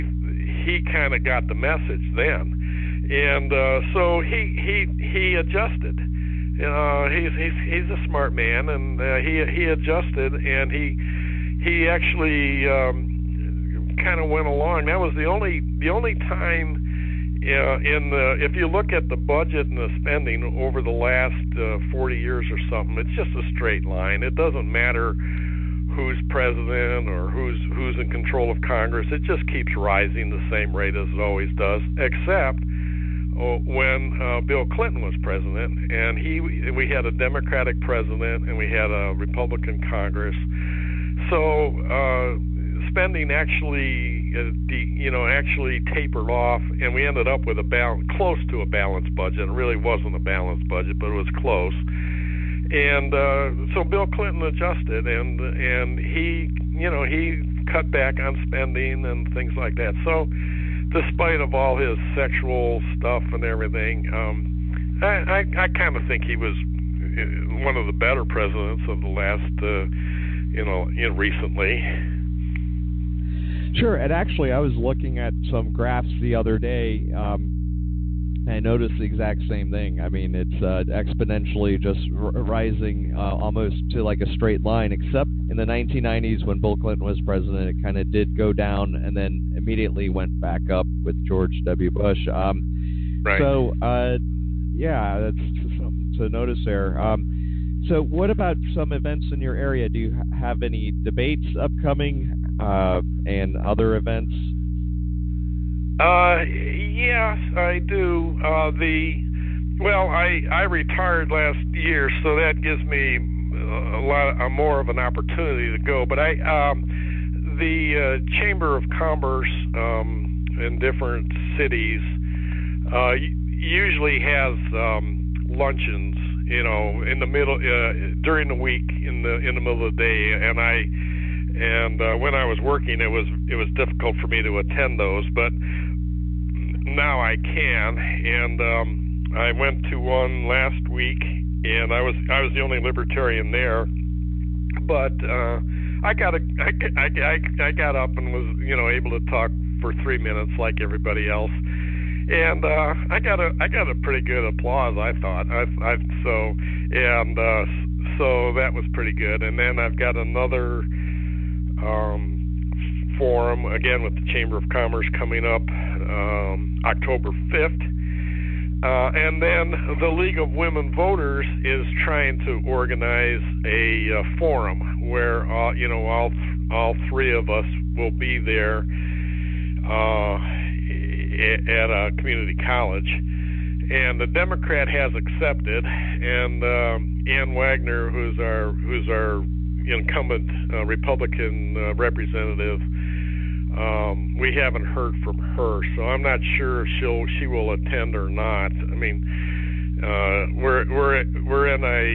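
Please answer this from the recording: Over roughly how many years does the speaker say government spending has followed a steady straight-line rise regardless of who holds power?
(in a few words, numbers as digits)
40 years.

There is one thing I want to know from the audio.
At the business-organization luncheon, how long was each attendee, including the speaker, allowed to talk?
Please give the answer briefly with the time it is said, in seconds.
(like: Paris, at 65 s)
3 minutes, at 150 s.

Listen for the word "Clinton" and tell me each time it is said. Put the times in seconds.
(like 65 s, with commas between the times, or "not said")
34 s, 54 s, 86 s.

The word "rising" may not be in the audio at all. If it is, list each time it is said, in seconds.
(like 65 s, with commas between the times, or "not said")
29 s, 82 s.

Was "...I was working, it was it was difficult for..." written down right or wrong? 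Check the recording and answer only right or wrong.
right.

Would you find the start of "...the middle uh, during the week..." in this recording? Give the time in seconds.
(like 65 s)
127 s.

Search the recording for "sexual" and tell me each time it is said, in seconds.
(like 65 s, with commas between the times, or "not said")
62 s.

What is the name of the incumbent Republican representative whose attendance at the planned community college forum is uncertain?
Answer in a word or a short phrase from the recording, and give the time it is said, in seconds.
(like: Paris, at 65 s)
Ann Wagner, at 187 s.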